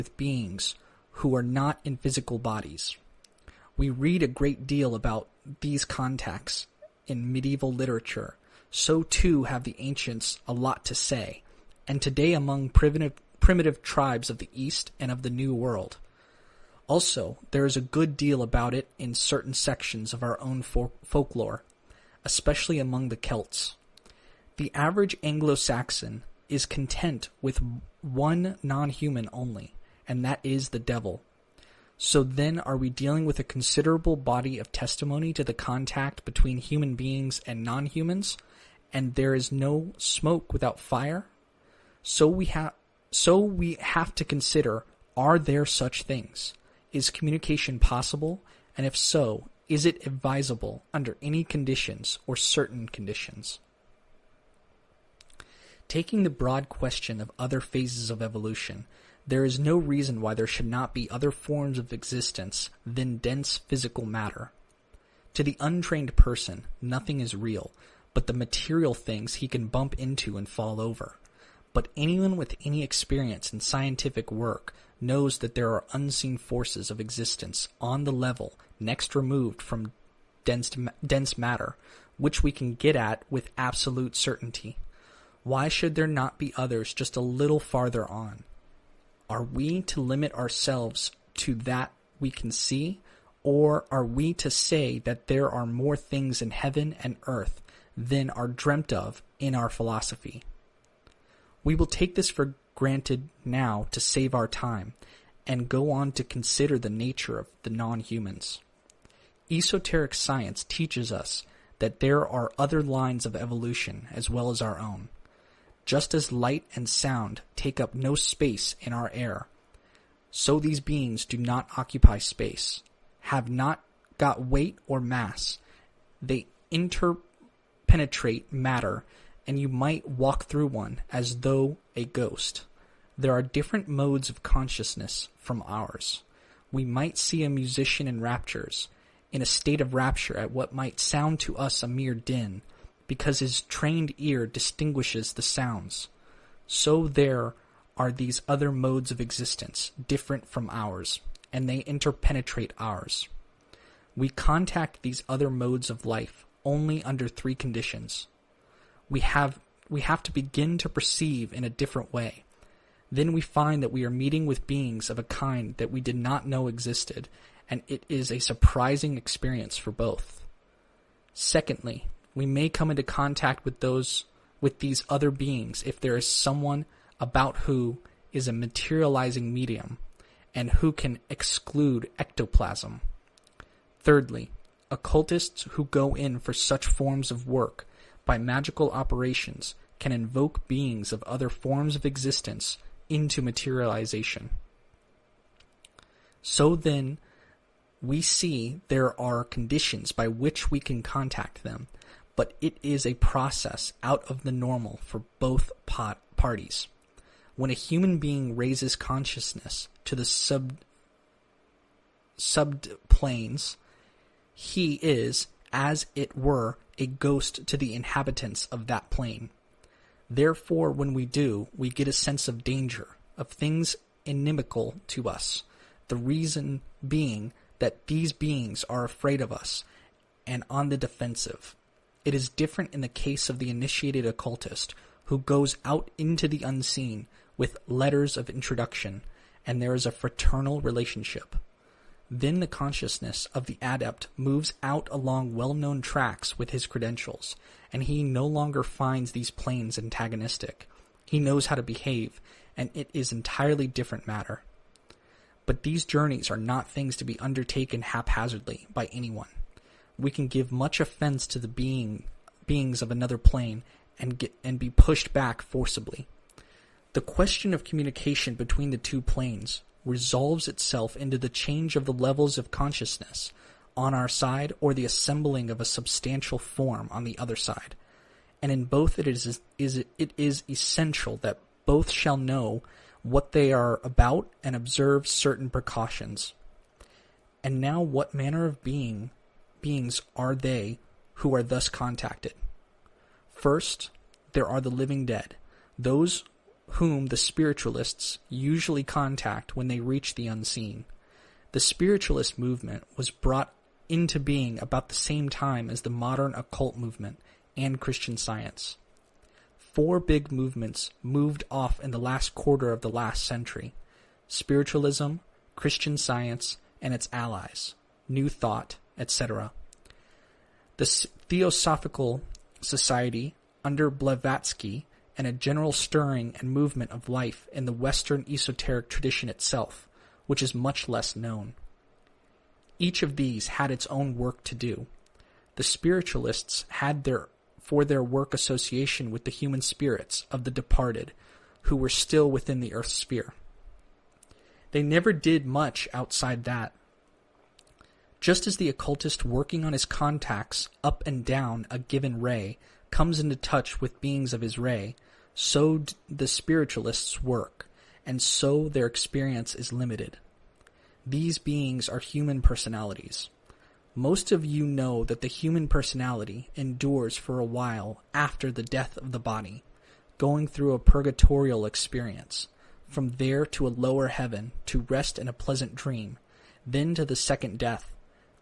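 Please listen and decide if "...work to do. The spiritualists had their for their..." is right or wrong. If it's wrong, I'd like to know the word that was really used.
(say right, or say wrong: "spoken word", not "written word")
right.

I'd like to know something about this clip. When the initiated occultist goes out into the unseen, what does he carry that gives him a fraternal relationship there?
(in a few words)
Letters of introduction.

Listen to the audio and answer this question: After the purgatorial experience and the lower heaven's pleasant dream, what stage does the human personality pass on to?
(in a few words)
The second death.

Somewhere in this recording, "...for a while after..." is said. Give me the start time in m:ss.
6:07.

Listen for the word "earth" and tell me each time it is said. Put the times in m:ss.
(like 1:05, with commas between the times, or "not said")
1:37, 5:42.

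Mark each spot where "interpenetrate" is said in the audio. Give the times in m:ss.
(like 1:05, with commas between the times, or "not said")
2:06, 2:31.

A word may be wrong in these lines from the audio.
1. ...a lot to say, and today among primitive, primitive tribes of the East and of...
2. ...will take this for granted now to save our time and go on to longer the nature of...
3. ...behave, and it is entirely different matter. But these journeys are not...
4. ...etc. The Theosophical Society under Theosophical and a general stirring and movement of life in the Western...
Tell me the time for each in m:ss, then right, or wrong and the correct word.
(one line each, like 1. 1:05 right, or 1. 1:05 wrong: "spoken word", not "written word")
1. 0:10 right
2. 1:41 wrong: "consider", not "longer"
3. 4:11 right
4. 5:19 wrong: "Blavatsky", not "Theosophical".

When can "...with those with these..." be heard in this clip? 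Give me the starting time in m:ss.
2:53.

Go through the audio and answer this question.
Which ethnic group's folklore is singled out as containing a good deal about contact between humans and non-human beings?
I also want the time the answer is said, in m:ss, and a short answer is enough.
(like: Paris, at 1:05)
The Celts, at 0:23.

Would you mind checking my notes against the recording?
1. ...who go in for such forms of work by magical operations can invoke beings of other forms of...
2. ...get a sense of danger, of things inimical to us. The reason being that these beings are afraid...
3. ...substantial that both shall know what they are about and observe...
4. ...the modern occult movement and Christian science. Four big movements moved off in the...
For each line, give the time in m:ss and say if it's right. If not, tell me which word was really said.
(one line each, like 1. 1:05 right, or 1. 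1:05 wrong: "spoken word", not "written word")
1. 3:05 right
2. 3:41 right
3. 4:40 wrong: "essential", not "substantial"
4. 5:06 right.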